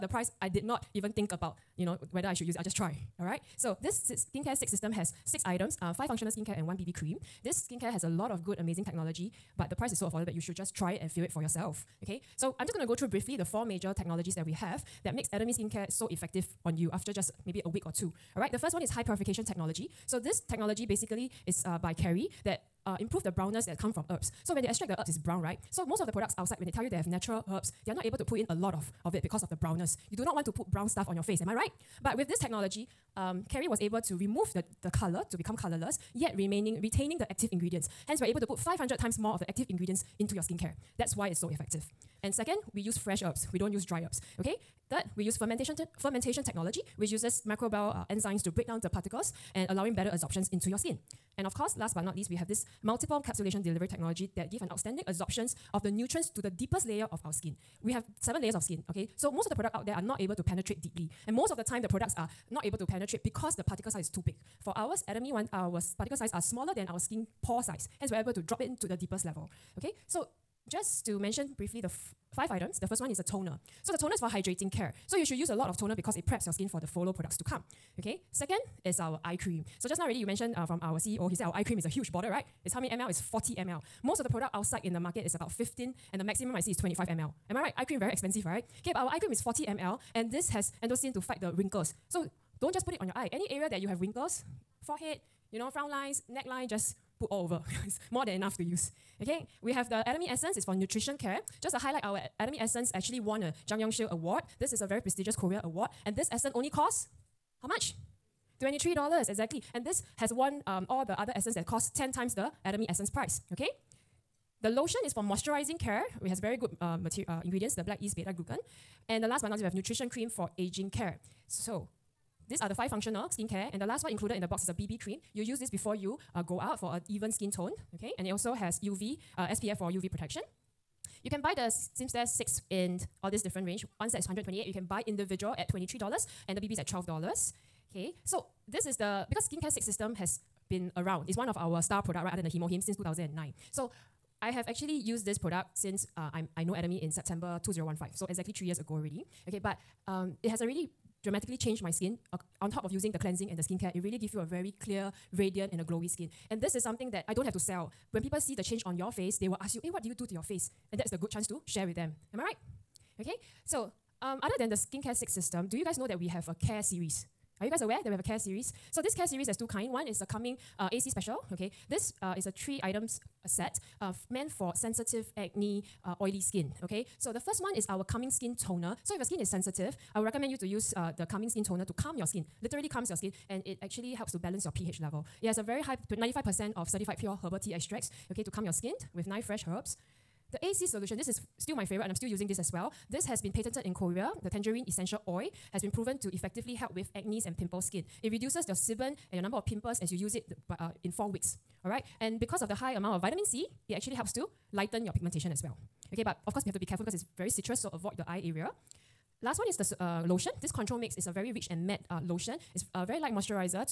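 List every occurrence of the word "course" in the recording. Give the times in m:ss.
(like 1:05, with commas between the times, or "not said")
0:51, 3:26.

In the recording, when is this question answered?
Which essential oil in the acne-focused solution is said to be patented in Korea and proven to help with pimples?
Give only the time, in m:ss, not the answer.
3:14.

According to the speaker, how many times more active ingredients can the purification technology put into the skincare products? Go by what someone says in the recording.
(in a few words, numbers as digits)
500 times.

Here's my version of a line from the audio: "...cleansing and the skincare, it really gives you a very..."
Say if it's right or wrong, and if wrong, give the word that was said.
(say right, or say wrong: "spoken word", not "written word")
right.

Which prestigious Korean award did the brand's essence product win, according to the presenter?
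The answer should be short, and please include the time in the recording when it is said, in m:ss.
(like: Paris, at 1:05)
Jang Yongshil Award, at 1:43.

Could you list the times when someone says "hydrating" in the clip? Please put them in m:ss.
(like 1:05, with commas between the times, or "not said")
1:14.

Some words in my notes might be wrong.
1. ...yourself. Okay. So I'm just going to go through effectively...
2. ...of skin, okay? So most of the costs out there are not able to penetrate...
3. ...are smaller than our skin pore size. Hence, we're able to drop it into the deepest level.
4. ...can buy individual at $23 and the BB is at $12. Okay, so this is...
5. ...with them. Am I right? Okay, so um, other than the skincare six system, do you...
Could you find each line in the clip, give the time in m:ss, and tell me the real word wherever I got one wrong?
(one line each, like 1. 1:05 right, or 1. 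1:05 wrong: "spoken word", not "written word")
1. 0:11 wrong: "briefly", not "effectively"
2. 0:58 wrong: "products", not "costs"
3. 1:06 right
4. 2:14 right
5. 2:41 right.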